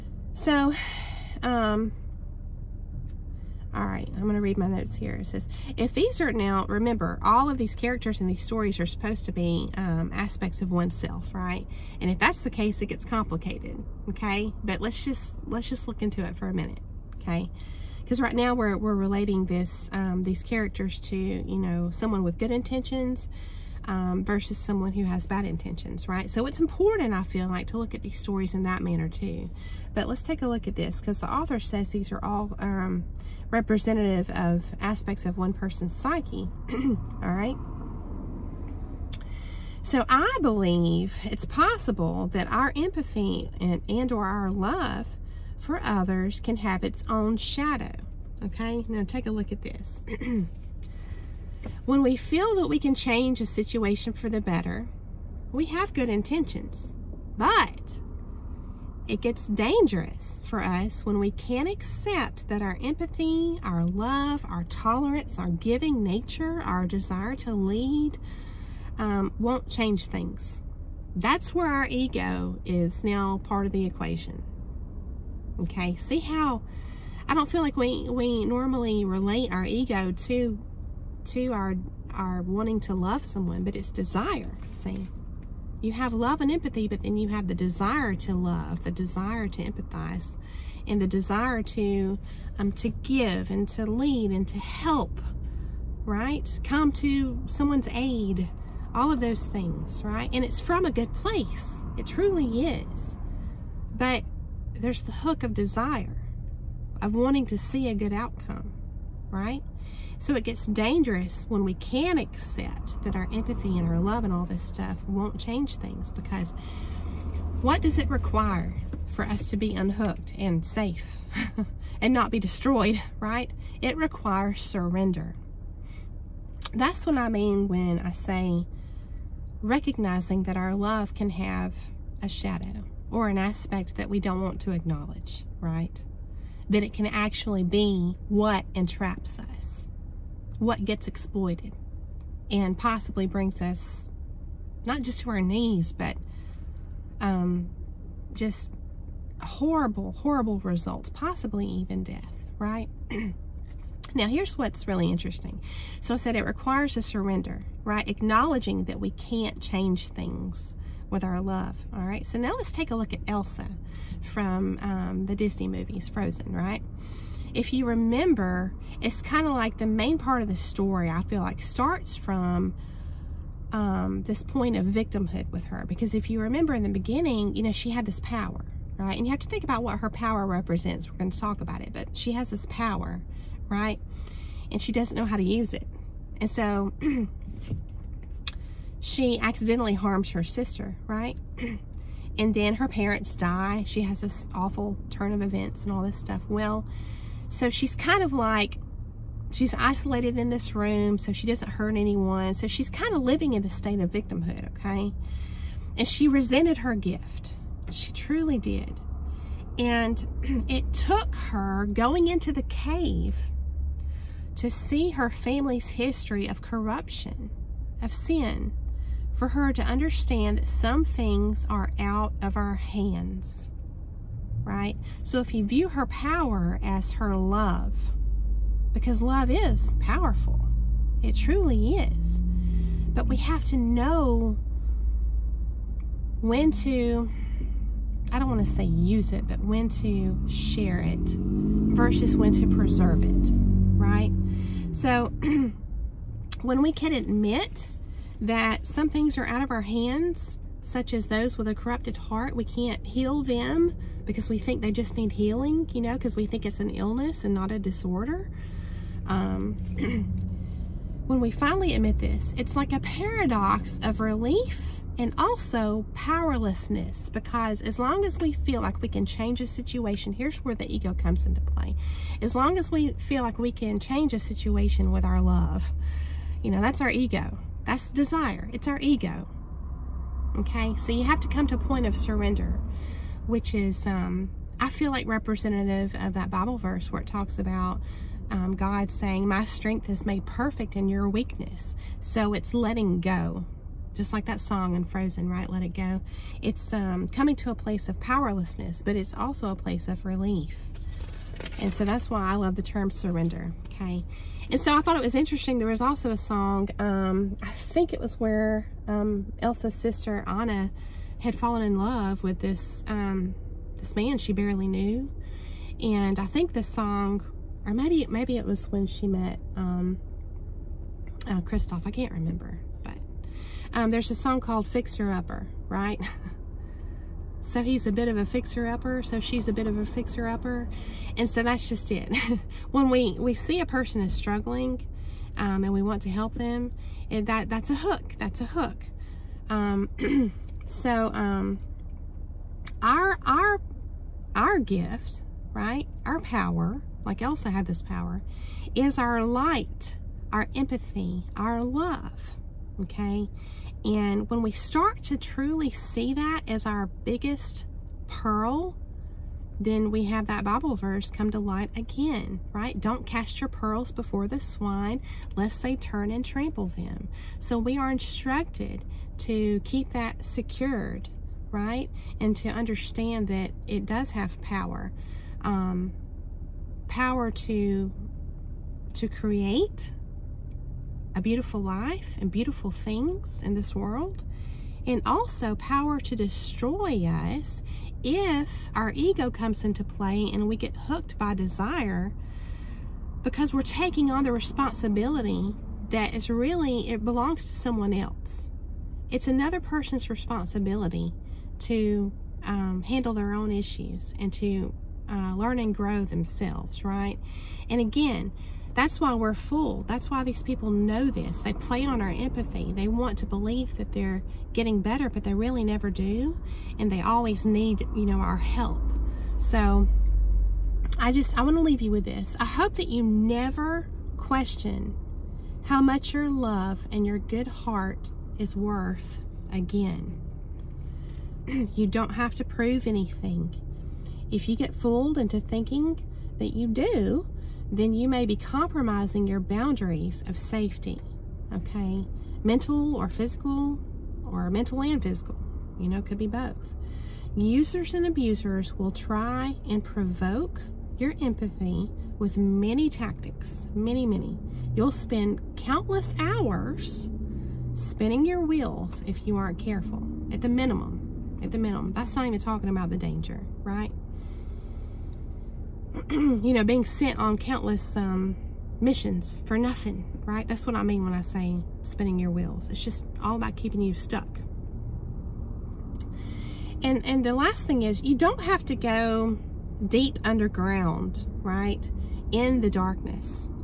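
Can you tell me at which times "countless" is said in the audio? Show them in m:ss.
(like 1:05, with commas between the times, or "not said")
7:35, 7:47.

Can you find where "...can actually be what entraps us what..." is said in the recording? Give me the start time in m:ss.
2:16.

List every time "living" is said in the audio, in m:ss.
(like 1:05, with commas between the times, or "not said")
3:23.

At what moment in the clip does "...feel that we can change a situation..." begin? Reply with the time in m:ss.
0:52.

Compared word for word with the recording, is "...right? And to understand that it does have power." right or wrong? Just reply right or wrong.
right.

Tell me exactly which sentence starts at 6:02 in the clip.
Don't cast your pearls before the swine, lest they turn and trample them.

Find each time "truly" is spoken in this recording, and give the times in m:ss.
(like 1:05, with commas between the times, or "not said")
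1:42, 3:28, 3:51, 5:55.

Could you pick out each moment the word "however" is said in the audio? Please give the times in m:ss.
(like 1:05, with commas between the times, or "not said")
not said.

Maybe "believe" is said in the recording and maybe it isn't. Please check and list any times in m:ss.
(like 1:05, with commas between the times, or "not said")
0:40, 6:53.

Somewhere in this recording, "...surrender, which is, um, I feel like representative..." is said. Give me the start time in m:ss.
4:42.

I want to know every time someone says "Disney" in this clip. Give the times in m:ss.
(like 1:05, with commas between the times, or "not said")
2:45.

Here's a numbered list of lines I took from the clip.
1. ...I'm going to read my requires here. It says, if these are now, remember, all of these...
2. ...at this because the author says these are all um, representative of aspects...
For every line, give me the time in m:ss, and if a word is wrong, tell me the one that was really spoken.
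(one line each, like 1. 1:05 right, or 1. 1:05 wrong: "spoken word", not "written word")
1. 0:04 wrong: "notes", not "requires"
2. 0:30 right.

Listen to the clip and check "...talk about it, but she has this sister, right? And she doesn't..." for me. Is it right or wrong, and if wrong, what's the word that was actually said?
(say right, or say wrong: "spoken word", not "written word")
wrong: "power", not "sister".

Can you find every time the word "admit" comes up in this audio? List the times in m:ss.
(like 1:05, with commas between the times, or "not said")
4:07, 4:21.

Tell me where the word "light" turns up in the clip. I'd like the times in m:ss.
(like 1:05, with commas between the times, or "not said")
5:49, 6:01.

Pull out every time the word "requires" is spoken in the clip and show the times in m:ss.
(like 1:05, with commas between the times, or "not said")
1:58, 2:03, 2:36.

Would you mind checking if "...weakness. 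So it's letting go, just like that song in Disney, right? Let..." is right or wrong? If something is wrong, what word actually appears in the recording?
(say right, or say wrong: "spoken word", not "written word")
wrong: "Frozen", not "Disney".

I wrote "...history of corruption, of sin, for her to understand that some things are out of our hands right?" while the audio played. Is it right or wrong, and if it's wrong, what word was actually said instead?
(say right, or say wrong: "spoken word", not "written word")
right.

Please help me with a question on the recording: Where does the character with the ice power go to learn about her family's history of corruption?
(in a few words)
The cave.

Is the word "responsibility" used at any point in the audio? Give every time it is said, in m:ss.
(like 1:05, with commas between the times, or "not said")
6:34, 6:40.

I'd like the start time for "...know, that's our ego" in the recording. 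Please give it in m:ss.
4:36.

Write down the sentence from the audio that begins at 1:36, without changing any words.
Come to someone's aid, all of those things, right?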